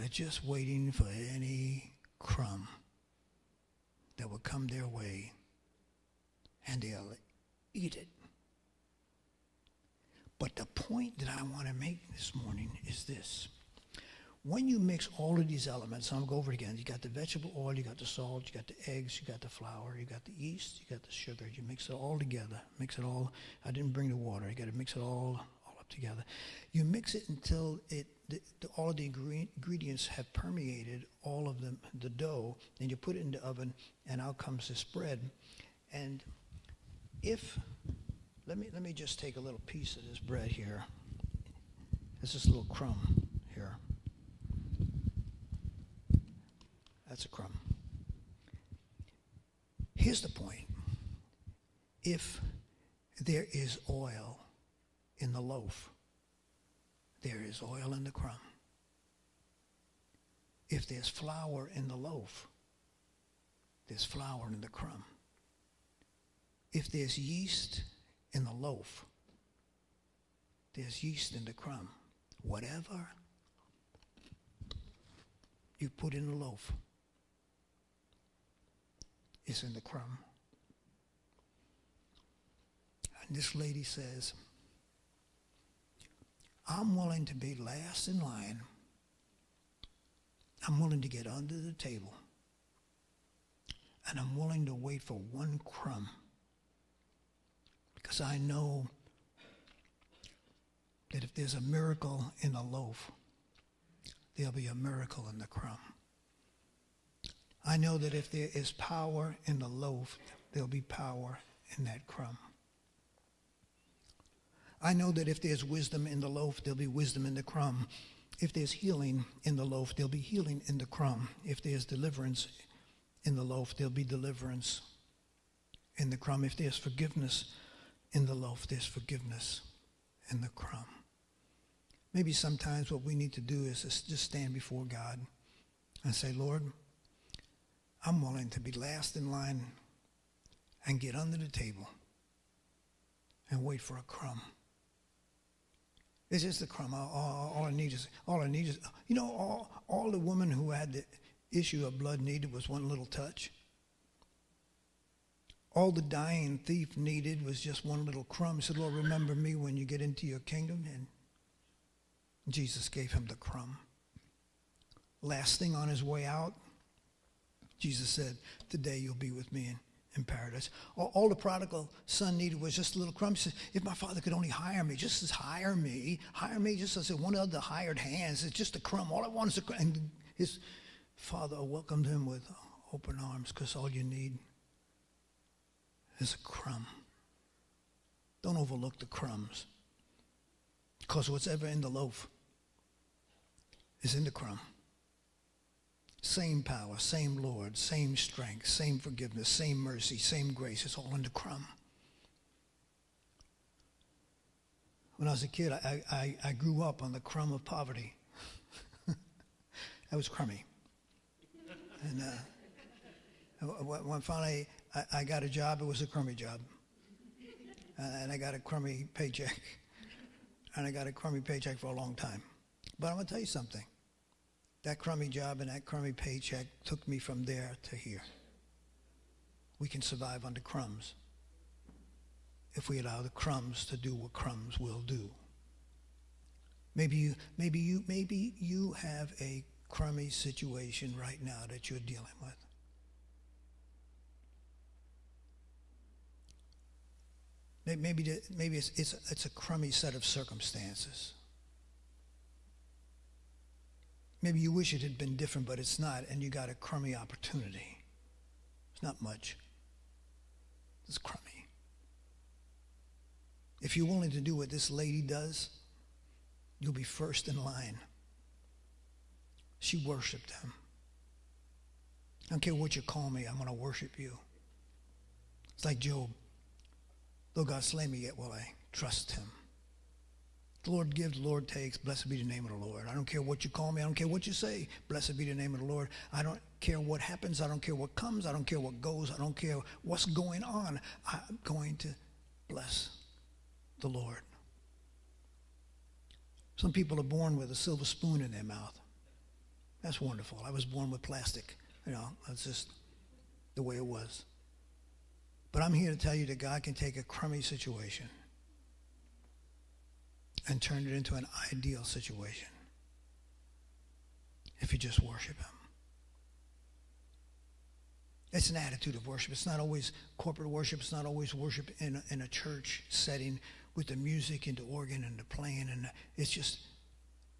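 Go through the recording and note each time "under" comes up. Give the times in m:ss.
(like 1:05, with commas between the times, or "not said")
1:31, 2:21.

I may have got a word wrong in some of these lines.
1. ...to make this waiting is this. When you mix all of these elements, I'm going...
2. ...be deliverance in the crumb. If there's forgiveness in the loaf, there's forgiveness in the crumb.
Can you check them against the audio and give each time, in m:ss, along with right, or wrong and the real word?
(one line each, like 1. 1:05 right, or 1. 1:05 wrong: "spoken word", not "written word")
1. 0:11 wrong: "morning", not "waiting"
2. 2:03 right.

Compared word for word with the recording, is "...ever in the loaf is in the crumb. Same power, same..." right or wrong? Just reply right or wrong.
right.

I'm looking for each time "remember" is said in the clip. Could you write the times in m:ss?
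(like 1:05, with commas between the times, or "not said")
2:38.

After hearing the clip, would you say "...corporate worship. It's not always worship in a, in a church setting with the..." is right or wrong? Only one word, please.
right.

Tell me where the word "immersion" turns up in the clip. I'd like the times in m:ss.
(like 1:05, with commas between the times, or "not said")
not said.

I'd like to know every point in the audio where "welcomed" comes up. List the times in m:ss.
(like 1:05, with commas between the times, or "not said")
3:01.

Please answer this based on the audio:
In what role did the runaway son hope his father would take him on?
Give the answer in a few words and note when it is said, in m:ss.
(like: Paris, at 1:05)
hired hands, at 2:57.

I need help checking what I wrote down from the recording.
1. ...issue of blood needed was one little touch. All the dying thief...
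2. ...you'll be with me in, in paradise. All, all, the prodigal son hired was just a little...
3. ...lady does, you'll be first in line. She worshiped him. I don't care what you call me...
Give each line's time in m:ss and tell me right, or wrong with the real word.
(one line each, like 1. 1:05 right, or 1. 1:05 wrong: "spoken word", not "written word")
1. 2:31 right
2. 2:48 wrong: "needed", not "hired"
3. 4:24 right.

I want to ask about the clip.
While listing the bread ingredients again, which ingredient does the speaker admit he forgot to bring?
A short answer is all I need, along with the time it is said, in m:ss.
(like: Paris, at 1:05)
water, at 0:23.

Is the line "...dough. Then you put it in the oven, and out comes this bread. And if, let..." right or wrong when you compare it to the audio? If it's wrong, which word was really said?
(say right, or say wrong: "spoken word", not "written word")
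right.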